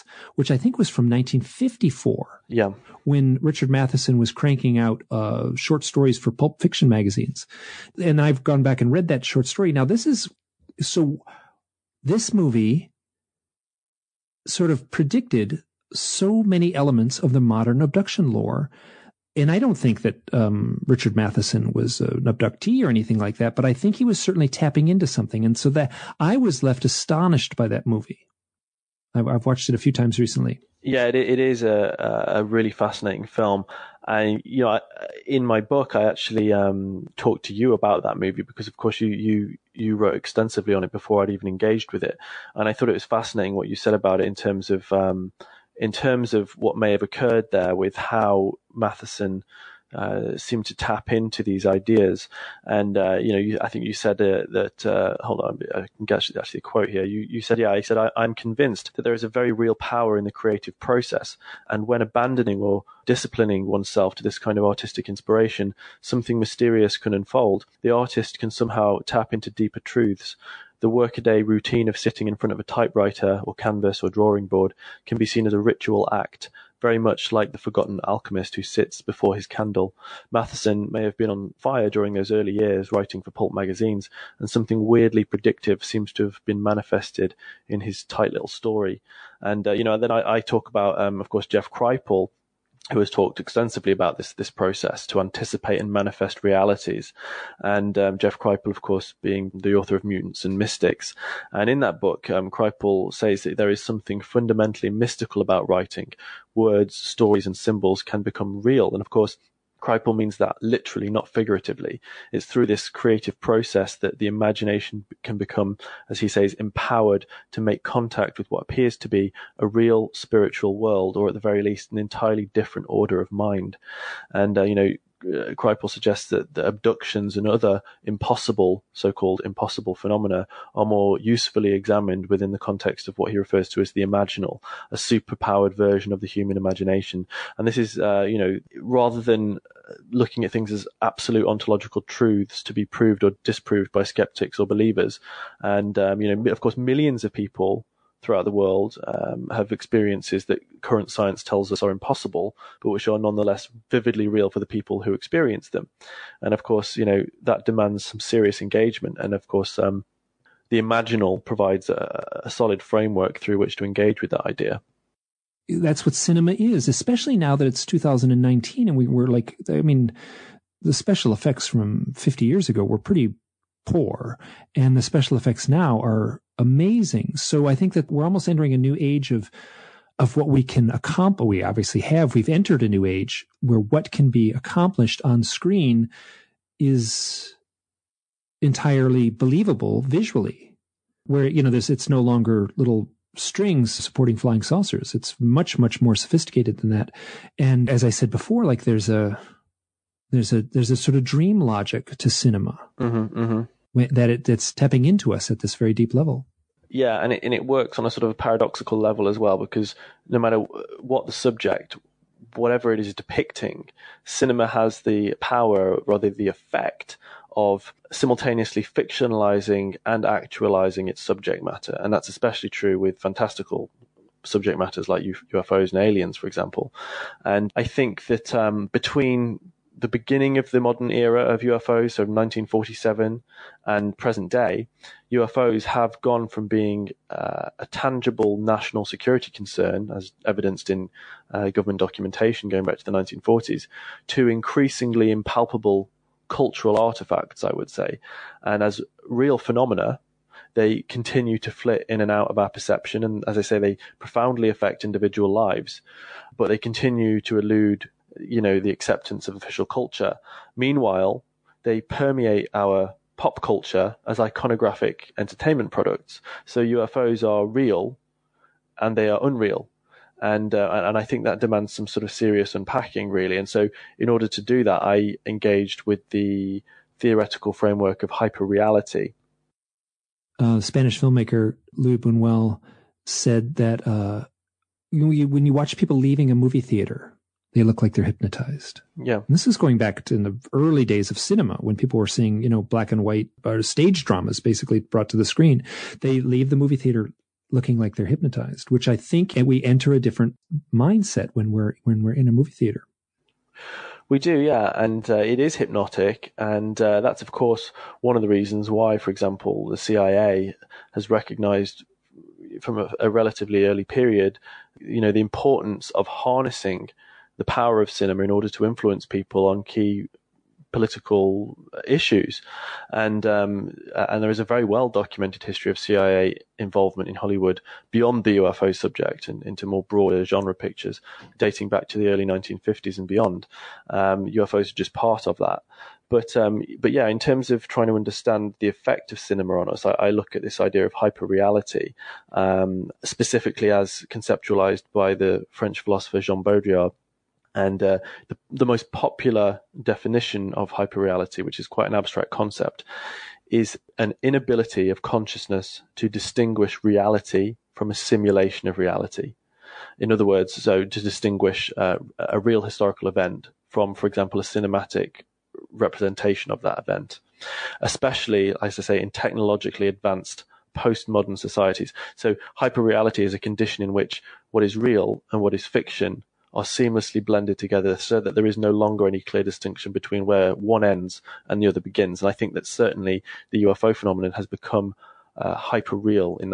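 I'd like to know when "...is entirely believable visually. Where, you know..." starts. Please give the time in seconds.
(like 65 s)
186 s.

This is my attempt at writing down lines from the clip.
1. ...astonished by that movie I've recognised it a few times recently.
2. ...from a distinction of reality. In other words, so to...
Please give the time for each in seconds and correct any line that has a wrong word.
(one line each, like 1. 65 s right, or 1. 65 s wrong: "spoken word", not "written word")
1. 26 s wrong: "watched", not "recognised"
2. 357 s wrong: "simulation", not "distinction".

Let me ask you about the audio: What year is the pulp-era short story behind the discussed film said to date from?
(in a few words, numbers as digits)
1954.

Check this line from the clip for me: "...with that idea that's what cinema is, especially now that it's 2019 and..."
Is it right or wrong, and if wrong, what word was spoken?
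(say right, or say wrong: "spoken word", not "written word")
right.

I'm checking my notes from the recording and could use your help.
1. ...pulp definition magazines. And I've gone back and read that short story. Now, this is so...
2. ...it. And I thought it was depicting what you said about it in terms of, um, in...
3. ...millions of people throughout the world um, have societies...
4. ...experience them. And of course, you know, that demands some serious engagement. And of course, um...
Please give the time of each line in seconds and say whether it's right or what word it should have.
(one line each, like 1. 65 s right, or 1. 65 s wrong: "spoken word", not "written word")
1. 6 s wrong: "fiction", not "definition"
2. 42 s wrong: "fascinating", not "depicting"
3. 146 s wrong: "experiences", not "societies"
4. 155 s right.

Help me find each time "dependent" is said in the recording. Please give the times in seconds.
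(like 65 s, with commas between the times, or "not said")
not said.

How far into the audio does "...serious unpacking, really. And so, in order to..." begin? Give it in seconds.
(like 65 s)
272 s.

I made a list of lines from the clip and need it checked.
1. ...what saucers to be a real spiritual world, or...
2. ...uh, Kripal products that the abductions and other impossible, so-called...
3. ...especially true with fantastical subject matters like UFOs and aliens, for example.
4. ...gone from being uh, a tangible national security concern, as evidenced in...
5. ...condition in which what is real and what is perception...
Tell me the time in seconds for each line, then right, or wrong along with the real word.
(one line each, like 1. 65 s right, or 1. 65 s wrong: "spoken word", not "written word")
1. 118 s wrong: "appears", not "saucers"
2. 125 s wrong: "suggests", not "products"
3. 222 s right
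4. 236 s right
5. 373 s wrong: "fiction", not "perception".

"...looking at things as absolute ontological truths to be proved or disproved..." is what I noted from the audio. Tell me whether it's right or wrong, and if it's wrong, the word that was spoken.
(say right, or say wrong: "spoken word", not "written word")
right.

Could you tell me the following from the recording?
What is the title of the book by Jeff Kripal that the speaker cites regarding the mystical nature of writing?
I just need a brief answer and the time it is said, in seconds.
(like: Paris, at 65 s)
Mutants and Mystics, at 100 s.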